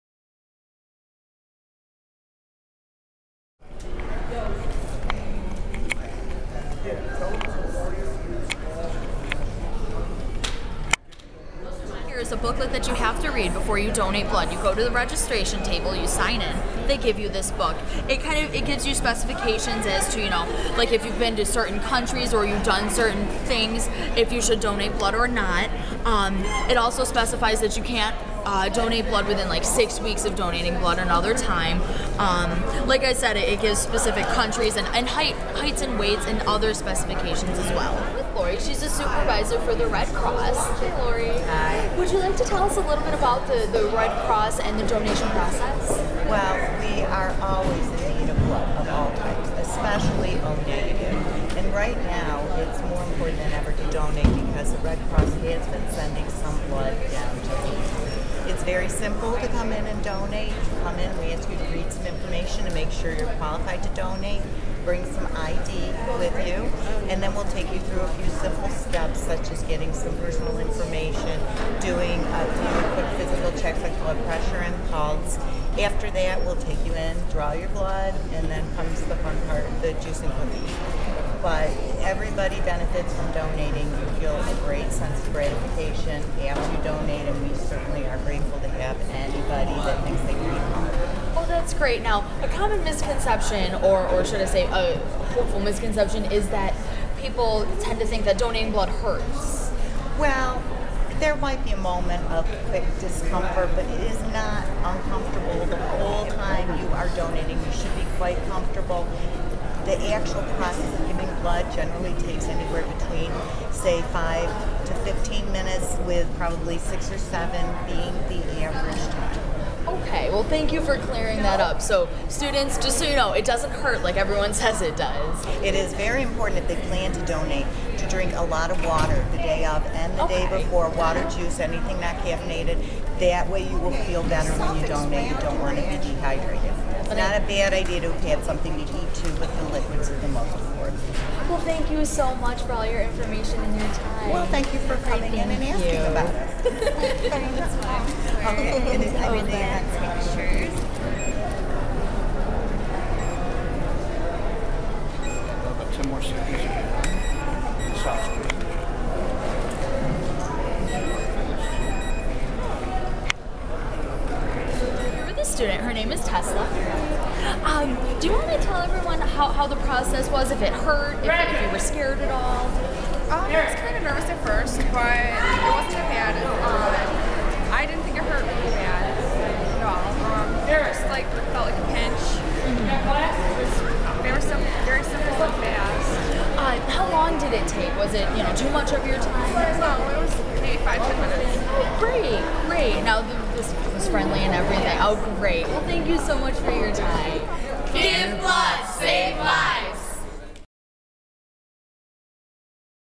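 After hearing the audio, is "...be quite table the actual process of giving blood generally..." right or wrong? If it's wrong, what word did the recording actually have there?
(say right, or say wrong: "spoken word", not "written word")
wrong: "comfortable", not "table".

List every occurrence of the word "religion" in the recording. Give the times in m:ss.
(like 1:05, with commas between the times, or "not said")
not said.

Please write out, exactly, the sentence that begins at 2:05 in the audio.
It is very important if they plan to donate to drink a lot of water the day of and the okay.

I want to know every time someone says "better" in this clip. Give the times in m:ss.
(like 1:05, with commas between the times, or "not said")
2:14.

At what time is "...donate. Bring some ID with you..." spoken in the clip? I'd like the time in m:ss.
1:03.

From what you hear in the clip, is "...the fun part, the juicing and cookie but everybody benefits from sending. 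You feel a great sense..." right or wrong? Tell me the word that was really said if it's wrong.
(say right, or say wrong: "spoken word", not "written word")
wrong: "donating", not "sending".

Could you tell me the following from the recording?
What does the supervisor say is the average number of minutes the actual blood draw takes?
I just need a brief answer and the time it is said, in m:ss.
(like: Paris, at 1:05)
6 or 7, at 1:56.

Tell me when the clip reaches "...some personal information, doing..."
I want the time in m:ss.
1:09.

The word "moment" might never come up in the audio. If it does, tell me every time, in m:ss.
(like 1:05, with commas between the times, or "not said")
1:41.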